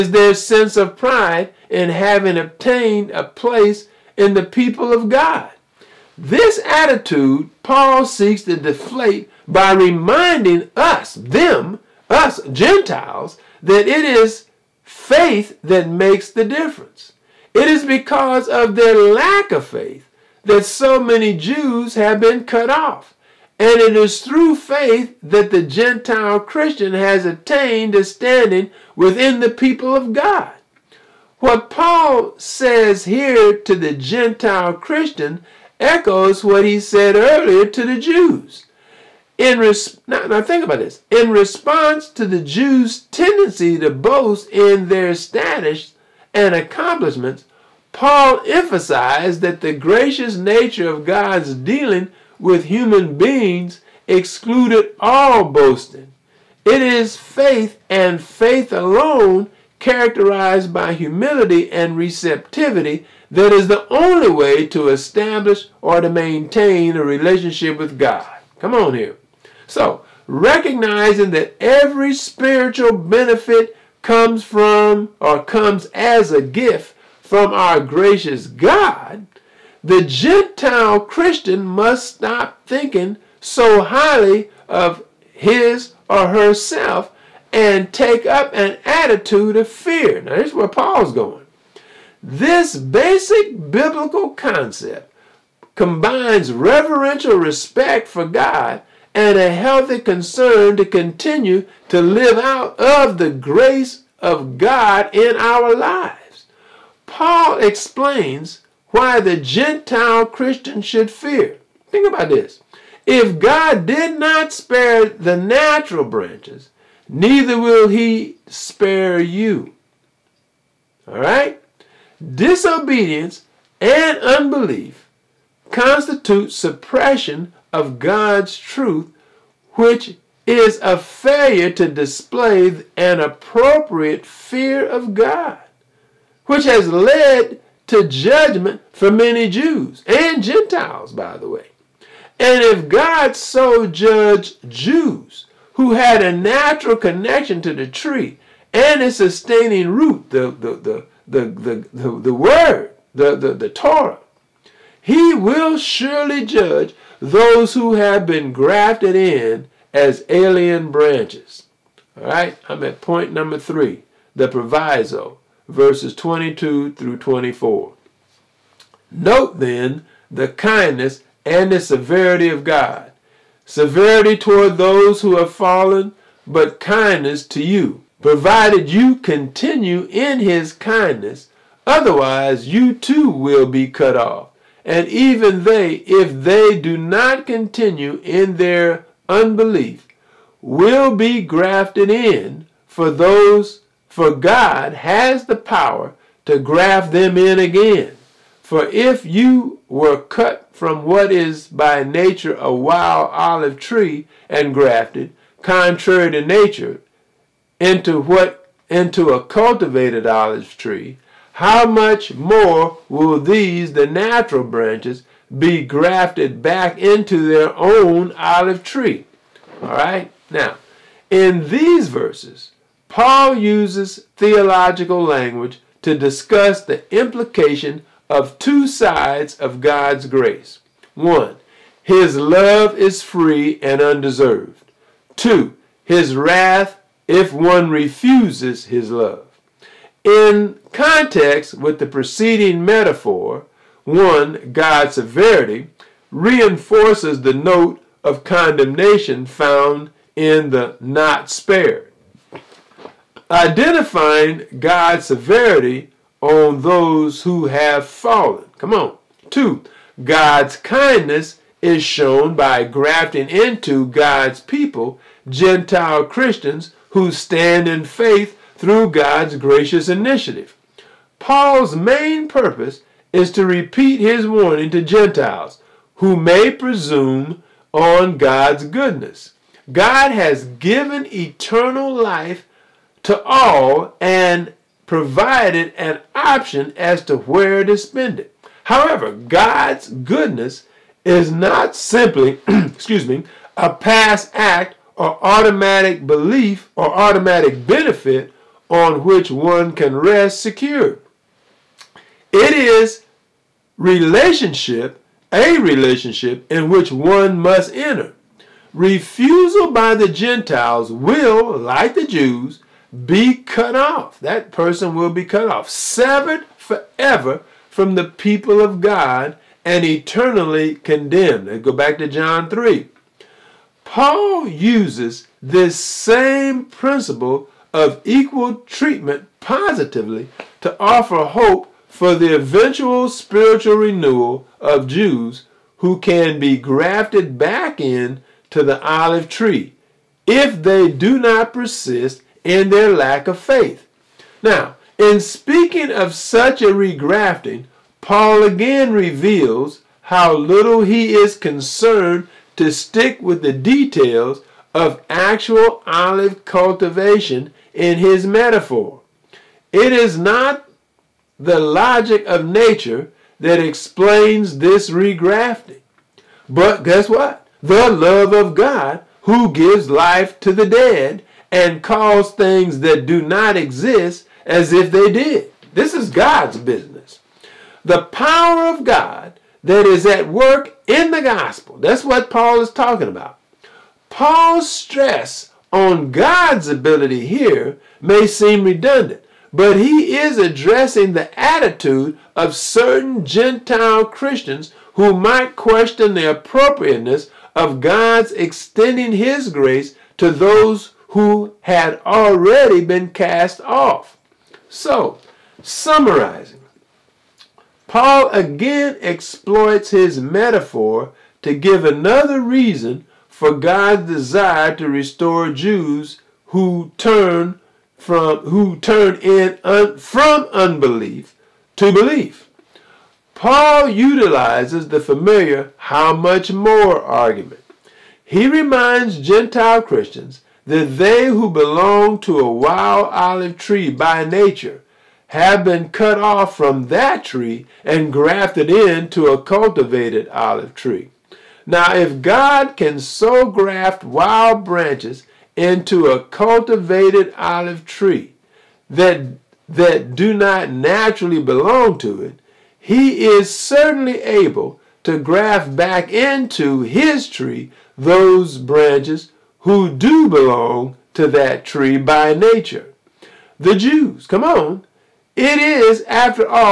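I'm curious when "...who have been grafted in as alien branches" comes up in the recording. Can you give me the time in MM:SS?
02:37.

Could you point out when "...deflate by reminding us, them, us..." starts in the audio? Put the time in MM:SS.
00:08.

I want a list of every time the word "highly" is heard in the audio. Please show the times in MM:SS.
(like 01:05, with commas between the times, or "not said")
01:23.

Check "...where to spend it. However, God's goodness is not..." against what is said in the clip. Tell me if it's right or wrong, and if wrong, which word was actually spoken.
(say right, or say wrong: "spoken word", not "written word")
right.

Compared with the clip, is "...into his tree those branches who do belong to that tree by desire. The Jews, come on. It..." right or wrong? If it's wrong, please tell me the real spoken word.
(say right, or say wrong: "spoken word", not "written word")
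wrong: "nature", not "desire".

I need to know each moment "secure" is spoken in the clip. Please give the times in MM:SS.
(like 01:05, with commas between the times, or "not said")
05:00.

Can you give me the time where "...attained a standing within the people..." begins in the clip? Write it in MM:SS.
00:27.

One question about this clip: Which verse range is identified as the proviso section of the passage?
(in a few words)
22 through 24.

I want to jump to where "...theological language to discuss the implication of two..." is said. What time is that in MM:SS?
03:44.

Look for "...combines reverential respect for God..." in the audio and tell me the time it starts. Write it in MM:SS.
01:35.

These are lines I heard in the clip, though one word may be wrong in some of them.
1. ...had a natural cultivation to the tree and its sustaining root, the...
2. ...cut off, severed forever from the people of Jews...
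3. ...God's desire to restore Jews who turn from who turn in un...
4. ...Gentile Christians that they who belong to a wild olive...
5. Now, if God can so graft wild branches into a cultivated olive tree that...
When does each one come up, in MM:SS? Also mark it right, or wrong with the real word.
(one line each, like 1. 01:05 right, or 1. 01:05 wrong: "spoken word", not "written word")
1. 02:25 wrong: "connection", not "cultivation"
2. 05:15 wrong: "God", not "Jews"
3. 06:53 right
4. 07:09 right
5. 07:21 right.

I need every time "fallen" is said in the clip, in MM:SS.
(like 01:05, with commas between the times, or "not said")
02:55, 04:18.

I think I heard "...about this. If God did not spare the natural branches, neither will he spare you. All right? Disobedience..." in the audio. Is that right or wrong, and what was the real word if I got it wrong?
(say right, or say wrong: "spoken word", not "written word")
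right.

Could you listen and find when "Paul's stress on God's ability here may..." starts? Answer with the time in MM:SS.
06:24.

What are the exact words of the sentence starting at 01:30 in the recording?
Now, this is where Paul's going.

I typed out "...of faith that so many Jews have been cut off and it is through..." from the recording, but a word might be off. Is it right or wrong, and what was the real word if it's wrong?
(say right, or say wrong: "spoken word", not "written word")
right.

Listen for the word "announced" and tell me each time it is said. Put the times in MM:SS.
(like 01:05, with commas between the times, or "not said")
not said.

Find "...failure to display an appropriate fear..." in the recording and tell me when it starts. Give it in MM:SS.
02:10.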